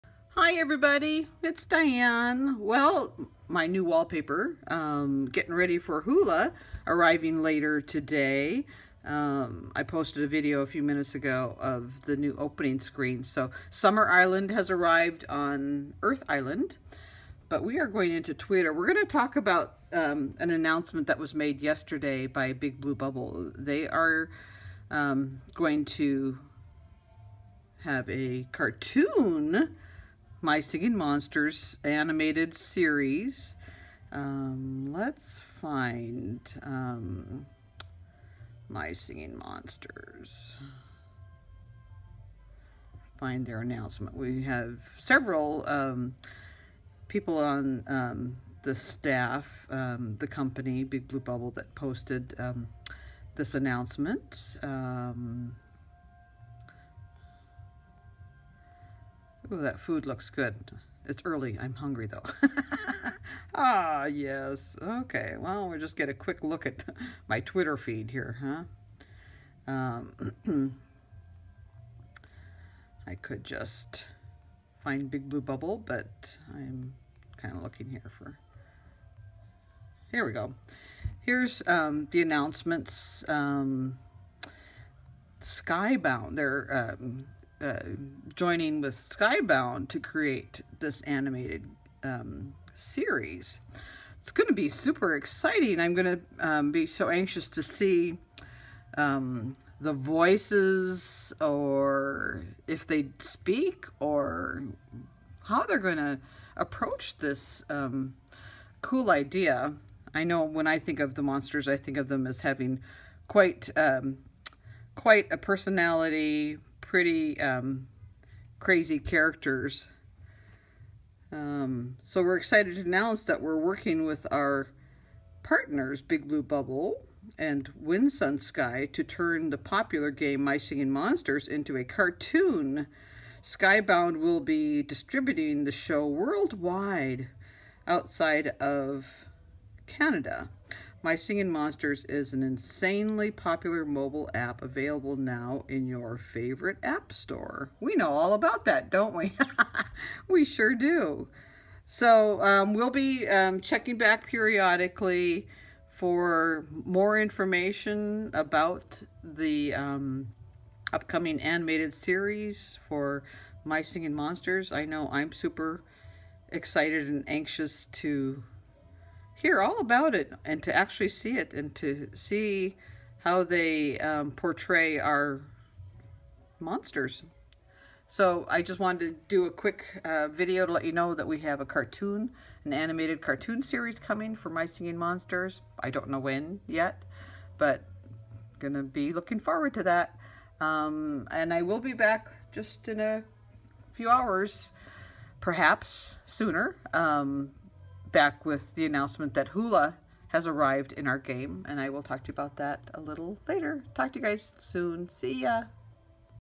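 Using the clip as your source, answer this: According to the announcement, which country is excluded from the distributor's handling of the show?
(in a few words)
Canada.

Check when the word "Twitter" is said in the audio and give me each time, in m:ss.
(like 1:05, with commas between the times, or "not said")
0:18, 1:07.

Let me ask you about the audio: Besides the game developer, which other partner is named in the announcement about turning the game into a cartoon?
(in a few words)
Wind Sun Sky.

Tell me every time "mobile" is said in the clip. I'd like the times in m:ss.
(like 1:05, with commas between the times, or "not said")
2:23.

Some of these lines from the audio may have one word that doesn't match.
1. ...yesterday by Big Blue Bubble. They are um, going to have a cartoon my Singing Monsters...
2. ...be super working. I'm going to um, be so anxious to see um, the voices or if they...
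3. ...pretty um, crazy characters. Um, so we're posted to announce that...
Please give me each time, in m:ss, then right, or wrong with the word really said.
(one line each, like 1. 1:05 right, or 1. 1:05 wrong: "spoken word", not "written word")
1. 0:21 right
2. 1:34 wrong: "exciting", not "working"
3. 1:56 wrong: "excited", not "posted".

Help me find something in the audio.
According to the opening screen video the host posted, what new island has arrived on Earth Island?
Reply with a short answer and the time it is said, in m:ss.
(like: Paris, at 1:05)
Summer Island, at 0:13.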